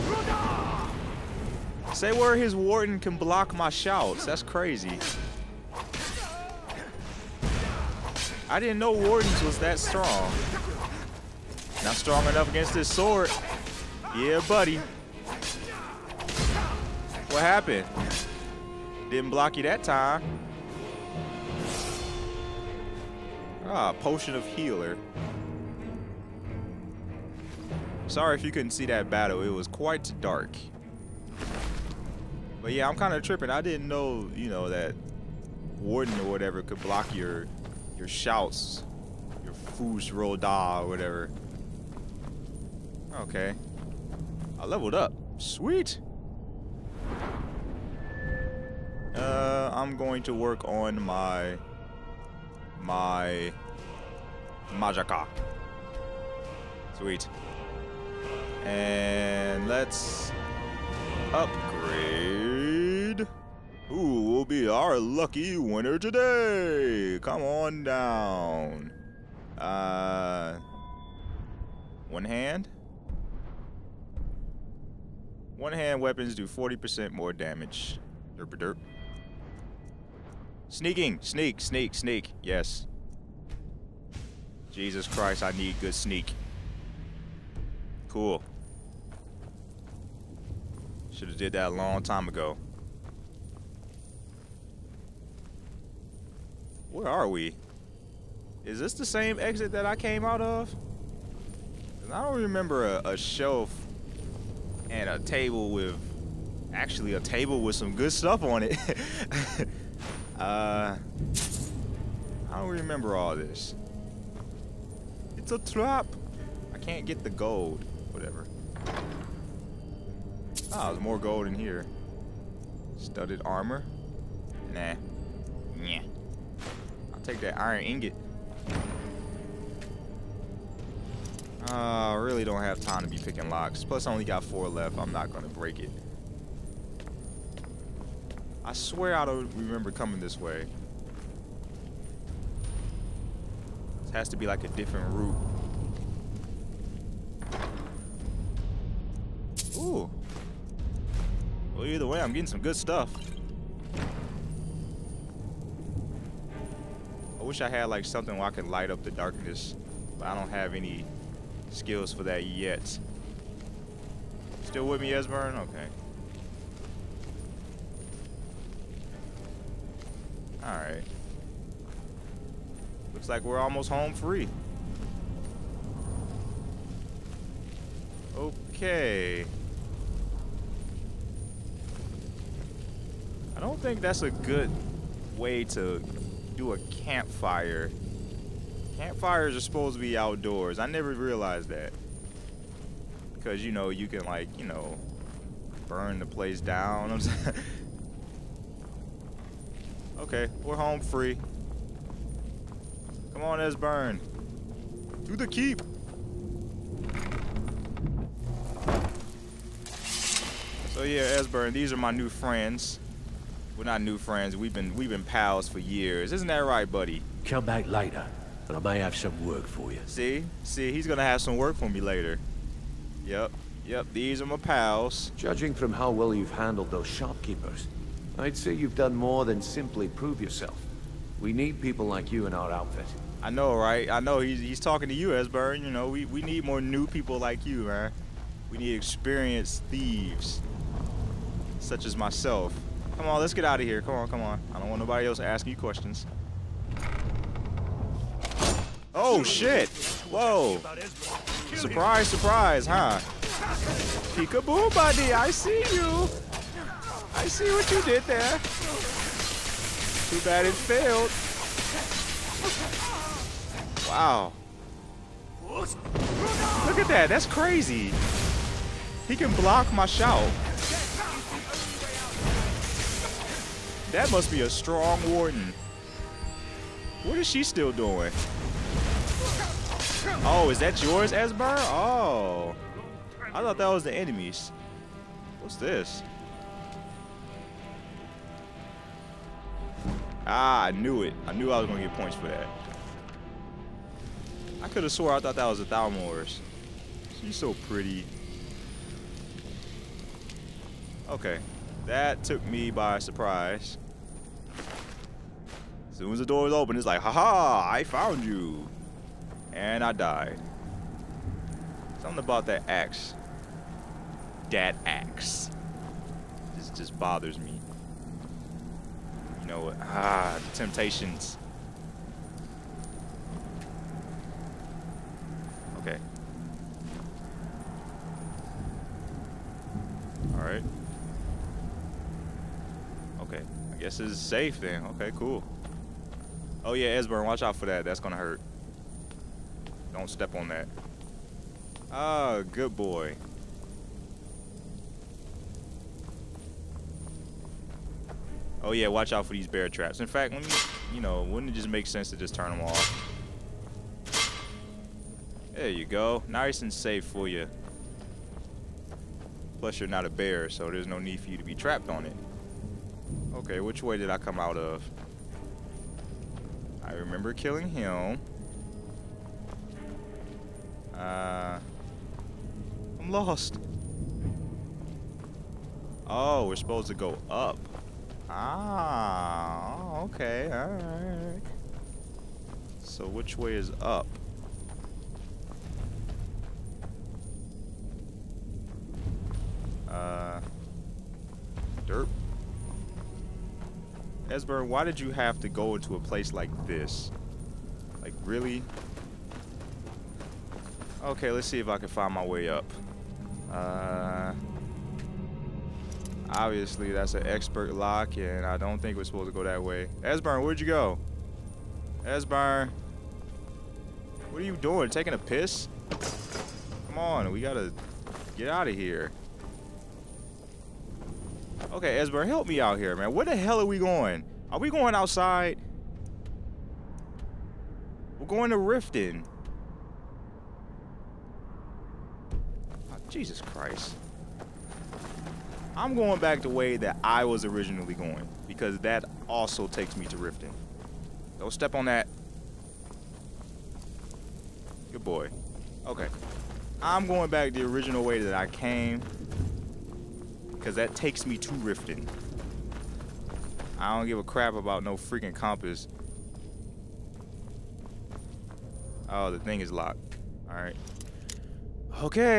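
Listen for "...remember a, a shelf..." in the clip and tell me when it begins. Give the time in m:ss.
1:42.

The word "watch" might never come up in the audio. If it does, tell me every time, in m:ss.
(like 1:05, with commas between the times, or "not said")
5:37, 5:49.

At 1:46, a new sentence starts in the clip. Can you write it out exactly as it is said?
Actually, a table with some good stuff on it.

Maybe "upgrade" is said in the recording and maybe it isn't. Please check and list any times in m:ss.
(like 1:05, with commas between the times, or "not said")
1:01.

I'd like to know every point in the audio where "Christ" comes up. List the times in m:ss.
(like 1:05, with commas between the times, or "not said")
1:25, 7:13.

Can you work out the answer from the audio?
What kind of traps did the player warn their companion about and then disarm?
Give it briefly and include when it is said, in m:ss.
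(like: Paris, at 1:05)
Bear traps, at 5:49.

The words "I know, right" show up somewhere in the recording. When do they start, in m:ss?
3:53.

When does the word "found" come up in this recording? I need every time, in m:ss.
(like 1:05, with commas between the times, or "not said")
5:08.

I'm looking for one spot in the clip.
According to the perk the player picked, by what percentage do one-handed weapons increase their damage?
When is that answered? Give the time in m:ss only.
1:16.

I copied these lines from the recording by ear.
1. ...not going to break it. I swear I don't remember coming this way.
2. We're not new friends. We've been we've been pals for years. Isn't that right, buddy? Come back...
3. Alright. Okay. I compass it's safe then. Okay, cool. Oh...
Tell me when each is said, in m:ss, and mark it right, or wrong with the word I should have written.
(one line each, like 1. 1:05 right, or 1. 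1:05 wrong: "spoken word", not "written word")
1. 2:15 right
2. 3:33 right
3. 5:30 wrong: "guess", not "compass".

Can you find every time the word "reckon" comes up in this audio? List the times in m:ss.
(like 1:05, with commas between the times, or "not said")
not said.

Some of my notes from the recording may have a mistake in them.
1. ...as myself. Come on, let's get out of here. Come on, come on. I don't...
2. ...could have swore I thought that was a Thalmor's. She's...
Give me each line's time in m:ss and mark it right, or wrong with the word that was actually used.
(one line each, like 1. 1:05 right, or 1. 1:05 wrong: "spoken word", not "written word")
1. 4:02 right
2. 4:54 right.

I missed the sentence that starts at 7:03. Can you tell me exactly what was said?
Where the hell are we going?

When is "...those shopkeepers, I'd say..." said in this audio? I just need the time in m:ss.
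3:46.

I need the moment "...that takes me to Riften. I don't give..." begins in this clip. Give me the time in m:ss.
7:30.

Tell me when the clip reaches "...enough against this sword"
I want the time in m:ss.
0:12.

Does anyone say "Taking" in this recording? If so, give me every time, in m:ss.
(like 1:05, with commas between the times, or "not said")
6:55.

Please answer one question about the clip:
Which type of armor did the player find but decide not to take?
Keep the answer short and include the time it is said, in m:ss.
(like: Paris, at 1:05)
Studded armor, at 2:02.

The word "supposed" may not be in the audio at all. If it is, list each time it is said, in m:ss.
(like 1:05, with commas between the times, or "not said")
3:09, 6:16, 6:49.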